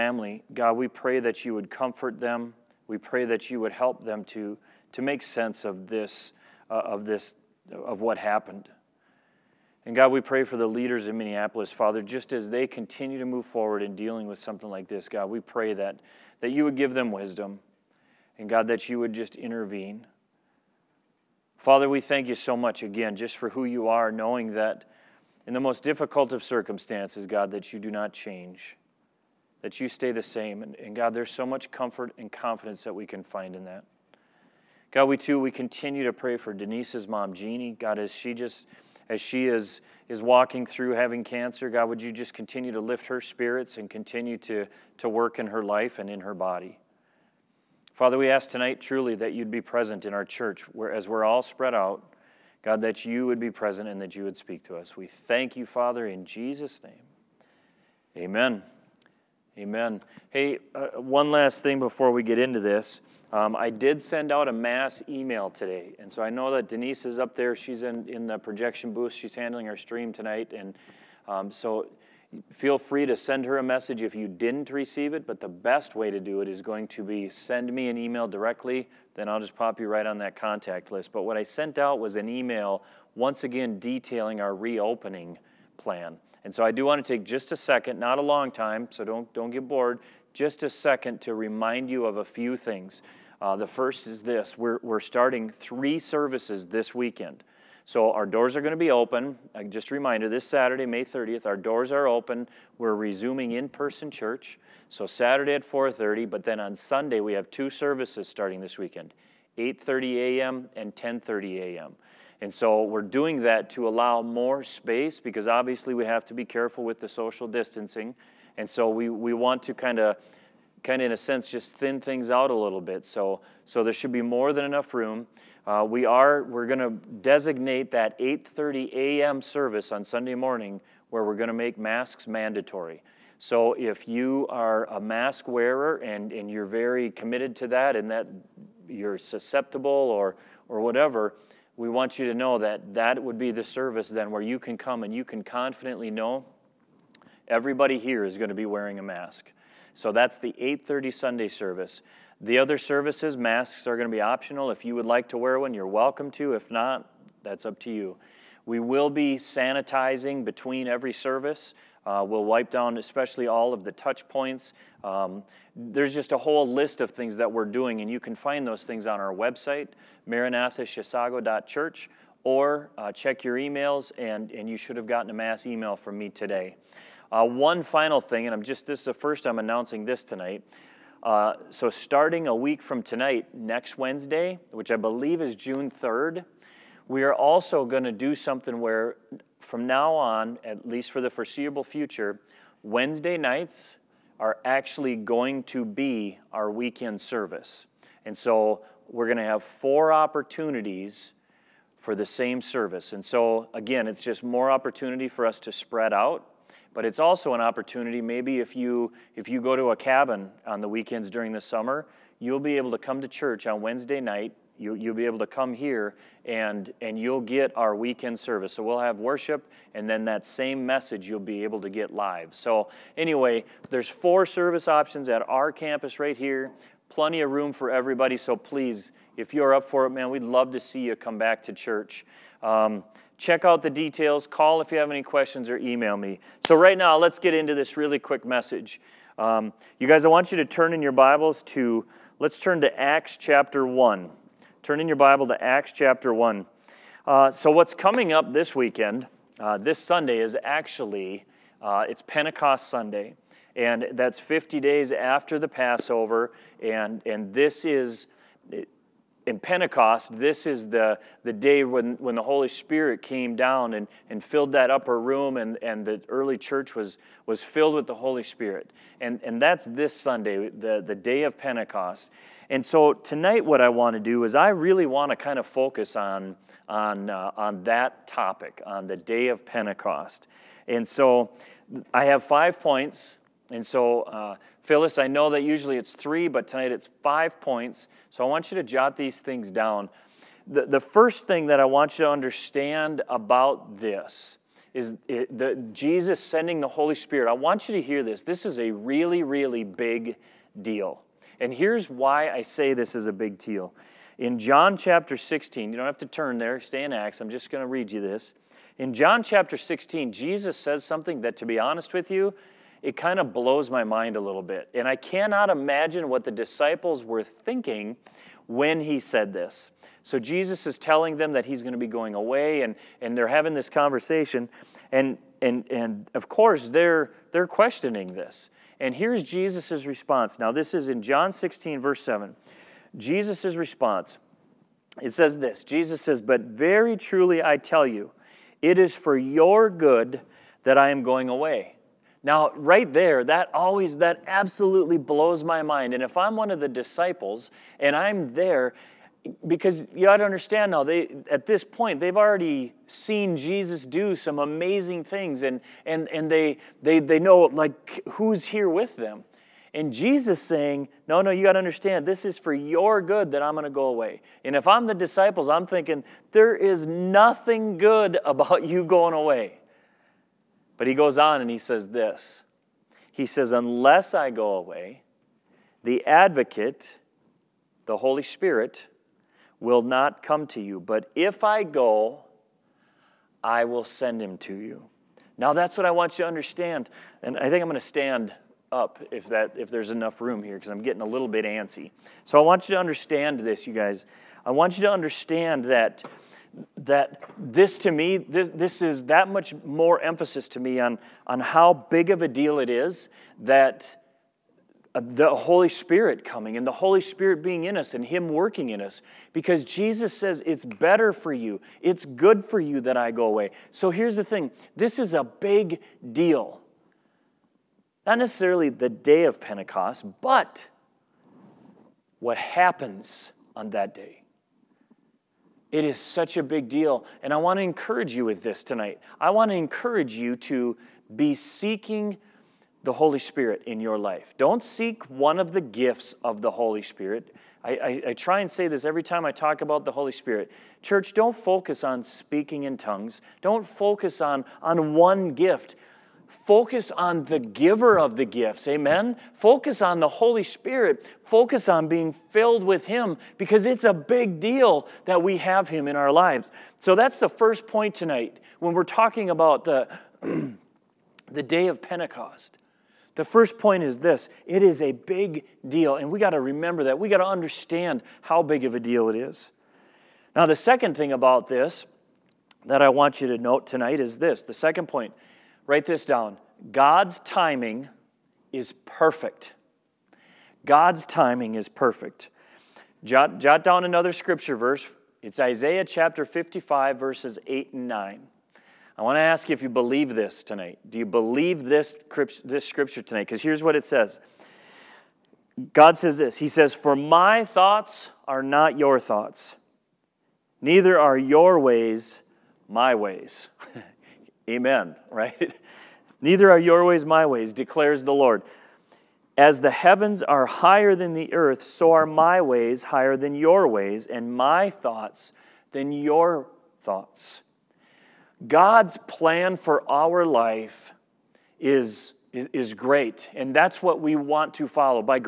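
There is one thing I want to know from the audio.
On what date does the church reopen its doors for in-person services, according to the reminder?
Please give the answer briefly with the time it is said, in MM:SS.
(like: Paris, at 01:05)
May 30th, at 01:40.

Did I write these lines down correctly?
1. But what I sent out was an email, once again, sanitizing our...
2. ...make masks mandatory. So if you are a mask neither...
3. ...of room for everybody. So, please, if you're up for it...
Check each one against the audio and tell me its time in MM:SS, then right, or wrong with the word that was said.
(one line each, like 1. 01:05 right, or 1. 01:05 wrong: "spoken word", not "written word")
1. 01:21 wrong: "detailing", not "sanitizing"
2. 02:11 wrong: "wearer", not "neither"
3. 03:47 right.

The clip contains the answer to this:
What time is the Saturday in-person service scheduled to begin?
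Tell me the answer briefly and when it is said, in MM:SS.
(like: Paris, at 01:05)
4:30, at 01:45.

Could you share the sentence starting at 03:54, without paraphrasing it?
Call if you have any questions or email me.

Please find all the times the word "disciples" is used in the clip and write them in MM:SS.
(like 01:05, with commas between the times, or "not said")
05:16, 05:46, 06:05.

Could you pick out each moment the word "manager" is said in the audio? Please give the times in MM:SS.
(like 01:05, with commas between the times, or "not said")
not said.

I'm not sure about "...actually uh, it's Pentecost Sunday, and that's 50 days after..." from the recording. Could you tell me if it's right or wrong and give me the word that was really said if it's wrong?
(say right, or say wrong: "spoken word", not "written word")
right.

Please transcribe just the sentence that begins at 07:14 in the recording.
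Don't seek one of the gifts of the Holy Spirit.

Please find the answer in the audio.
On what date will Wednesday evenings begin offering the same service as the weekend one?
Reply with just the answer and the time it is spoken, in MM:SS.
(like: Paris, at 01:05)
June 3rd, at 03:05.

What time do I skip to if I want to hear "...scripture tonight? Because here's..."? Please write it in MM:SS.
08:12.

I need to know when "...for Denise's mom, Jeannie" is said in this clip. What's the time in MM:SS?
00:36.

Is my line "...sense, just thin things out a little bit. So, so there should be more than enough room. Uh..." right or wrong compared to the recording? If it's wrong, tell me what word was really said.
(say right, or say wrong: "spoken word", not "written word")
right.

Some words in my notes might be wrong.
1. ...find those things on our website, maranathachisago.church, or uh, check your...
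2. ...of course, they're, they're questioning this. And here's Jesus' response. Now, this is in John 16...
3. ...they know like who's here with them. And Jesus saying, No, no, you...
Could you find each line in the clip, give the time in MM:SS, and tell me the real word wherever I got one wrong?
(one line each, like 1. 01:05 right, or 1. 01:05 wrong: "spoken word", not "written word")
1. 02:48 right
2. 05:26 right
3. 05:57 right.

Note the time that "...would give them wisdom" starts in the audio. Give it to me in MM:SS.
00:16.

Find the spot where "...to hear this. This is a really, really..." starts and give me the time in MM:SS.
04:57.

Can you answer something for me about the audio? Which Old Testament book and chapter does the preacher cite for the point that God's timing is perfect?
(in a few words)
Isaiah 55.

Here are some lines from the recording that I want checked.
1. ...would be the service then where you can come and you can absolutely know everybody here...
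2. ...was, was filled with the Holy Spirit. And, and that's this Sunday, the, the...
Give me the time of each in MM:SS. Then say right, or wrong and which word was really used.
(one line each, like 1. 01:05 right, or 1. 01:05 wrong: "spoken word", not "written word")
1. 02:23 wrong: "confidently", not "absolutely"
2. 04:26 right.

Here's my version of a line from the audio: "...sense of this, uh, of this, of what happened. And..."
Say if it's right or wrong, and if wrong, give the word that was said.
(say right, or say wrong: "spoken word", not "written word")
right.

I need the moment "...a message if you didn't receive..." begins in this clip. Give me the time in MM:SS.
01:13.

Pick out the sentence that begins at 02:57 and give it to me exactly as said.
Uh, one final thing, and I'm just this is the first I'm announcing this tonight.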